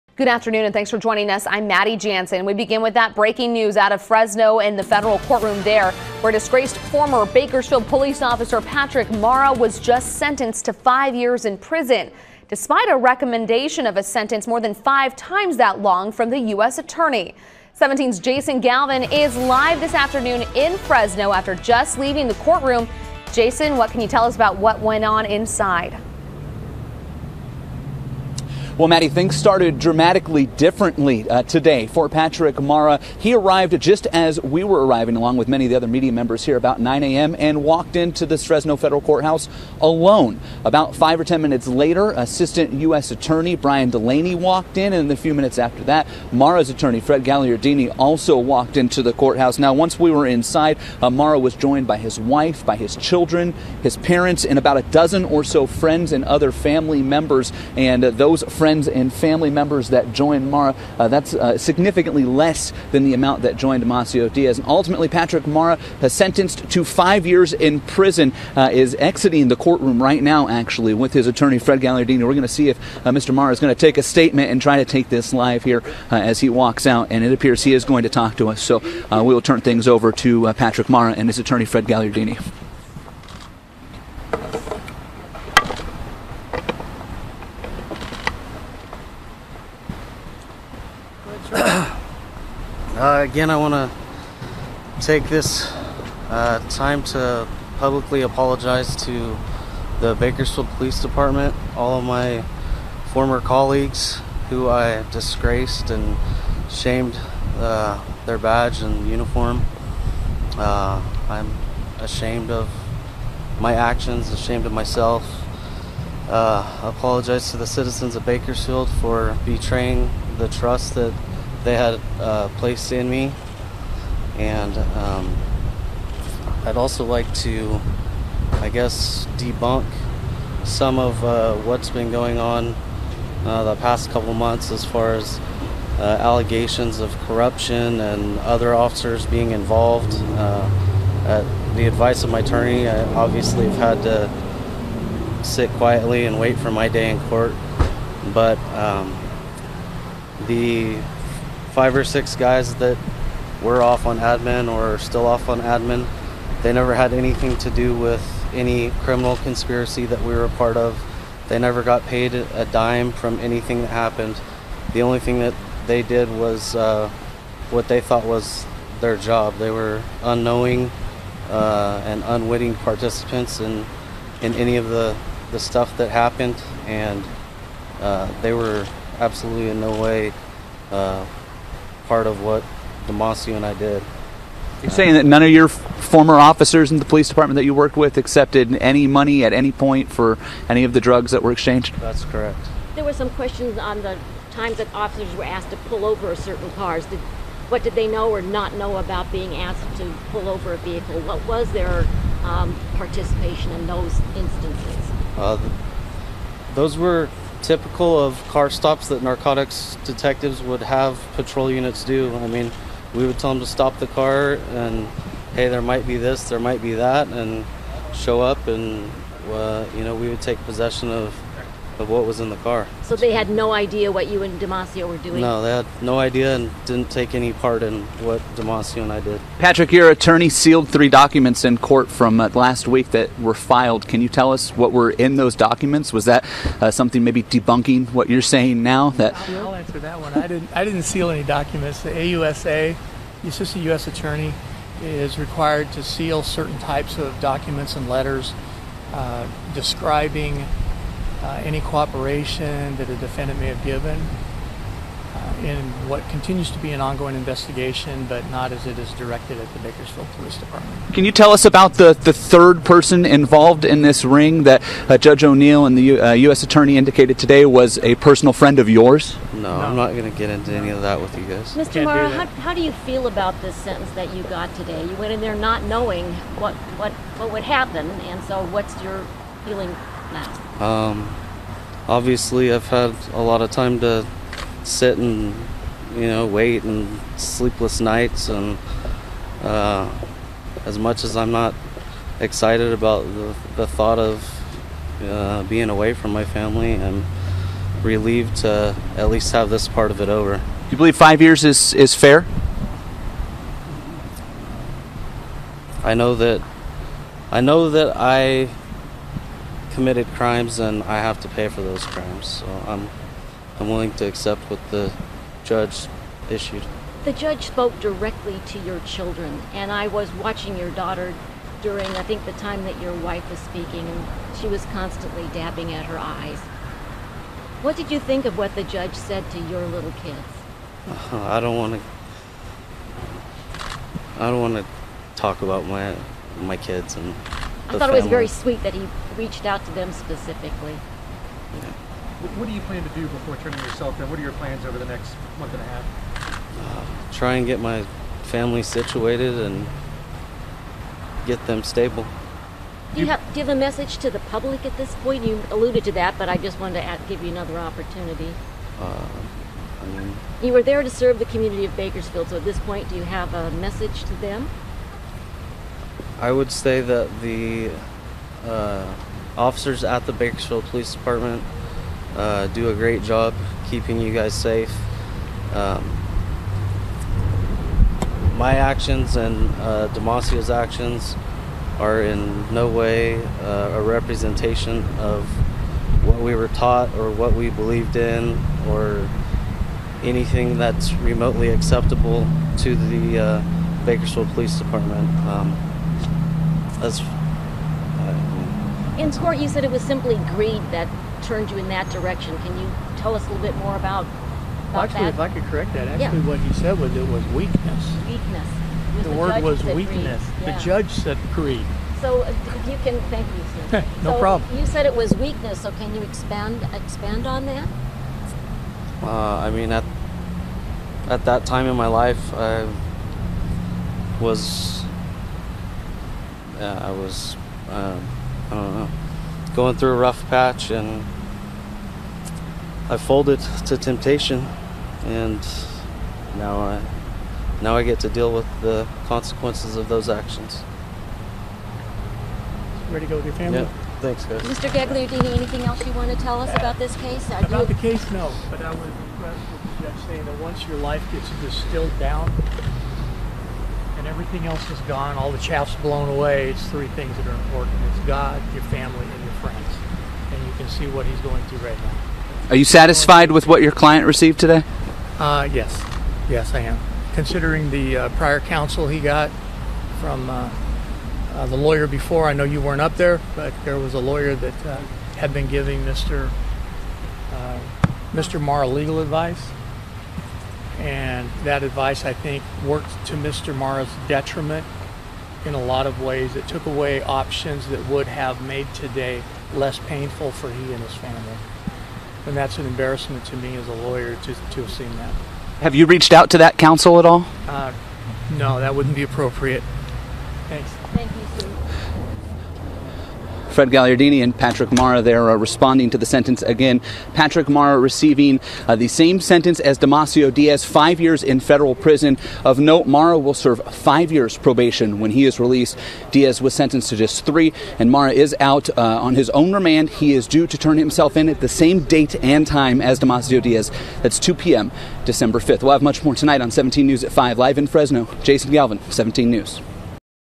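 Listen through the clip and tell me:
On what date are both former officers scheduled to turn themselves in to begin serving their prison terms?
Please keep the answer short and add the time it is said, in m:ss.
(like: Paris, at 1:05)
December 5, at 8:45.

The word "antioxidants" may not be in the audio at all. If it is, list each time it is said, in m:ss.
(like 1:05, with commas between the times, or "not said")
not said.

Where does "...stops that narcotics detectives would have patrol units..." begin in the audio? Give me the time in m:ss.
3:28.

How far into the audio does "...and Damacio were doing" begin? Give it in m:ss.
3:44.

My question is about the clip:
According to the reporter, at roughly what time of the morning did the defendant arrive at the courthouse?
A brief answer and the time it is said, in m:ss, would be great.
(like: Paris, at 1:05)
9 a.m., at 0:36.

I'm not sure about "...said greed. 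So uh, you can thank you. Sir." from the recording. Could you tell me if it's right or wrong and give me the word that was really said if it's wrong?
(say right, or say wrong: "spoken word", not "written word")
right.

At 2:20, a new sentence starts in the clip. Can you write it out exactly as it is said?
Uh, at the advice of my attorney, I obviously have had to sit quietly and wait for my day in court.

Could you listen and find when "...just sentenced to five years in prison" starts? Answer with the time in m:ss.
0:09.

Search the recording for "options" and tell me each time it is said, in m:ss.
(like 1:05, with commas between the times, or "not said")
8:07.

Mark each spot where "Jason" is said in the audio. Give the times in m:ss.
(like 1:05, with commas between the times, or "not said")
0:18, 0:23, 8:48.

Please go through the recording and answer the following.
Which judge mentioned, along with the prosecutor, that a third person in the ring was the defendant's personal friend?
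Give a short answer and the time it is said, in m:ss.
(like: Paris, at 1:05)
O'Neill, at 4:25.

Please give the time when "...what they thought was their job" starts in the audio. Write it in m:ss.
2:47.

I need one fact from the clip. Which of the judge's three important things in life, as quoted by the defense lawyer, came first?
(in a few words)
God.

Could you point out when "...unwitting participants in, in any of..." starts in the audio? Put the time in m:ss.
2:52.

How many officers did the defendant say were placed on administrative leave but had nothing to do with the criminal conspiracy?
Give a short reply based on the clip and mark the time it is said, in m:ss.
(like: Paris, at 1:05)
5 or 6, at 2:31.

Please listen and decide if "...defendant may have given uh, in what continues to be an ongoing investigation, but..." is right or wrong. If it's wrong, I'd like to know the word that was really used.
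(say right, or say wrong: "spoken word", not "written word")
right.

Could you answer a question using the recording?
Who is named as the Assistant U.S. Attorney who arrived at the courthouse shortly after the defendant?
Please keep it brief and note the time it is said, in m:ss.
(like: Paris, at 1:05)
Brian Delaney, at 0:43.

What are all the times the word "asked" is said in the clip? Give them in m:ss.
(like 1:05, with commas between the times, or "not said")
3:15, 3:19.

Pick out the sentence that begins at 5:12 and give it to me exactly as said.
So I'm, I'm willing to accept what the judge issued.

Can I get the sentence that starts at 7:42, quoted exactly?
Are you satisfied with what your client received today?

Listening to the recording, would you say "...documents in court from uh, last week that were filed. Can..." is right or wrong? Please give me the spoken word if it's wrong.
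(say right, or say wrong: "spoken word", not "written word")
right.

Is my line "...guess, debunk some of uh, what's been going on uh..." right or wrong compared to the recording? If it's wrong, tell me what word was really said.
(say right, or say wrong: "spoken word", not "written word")
right.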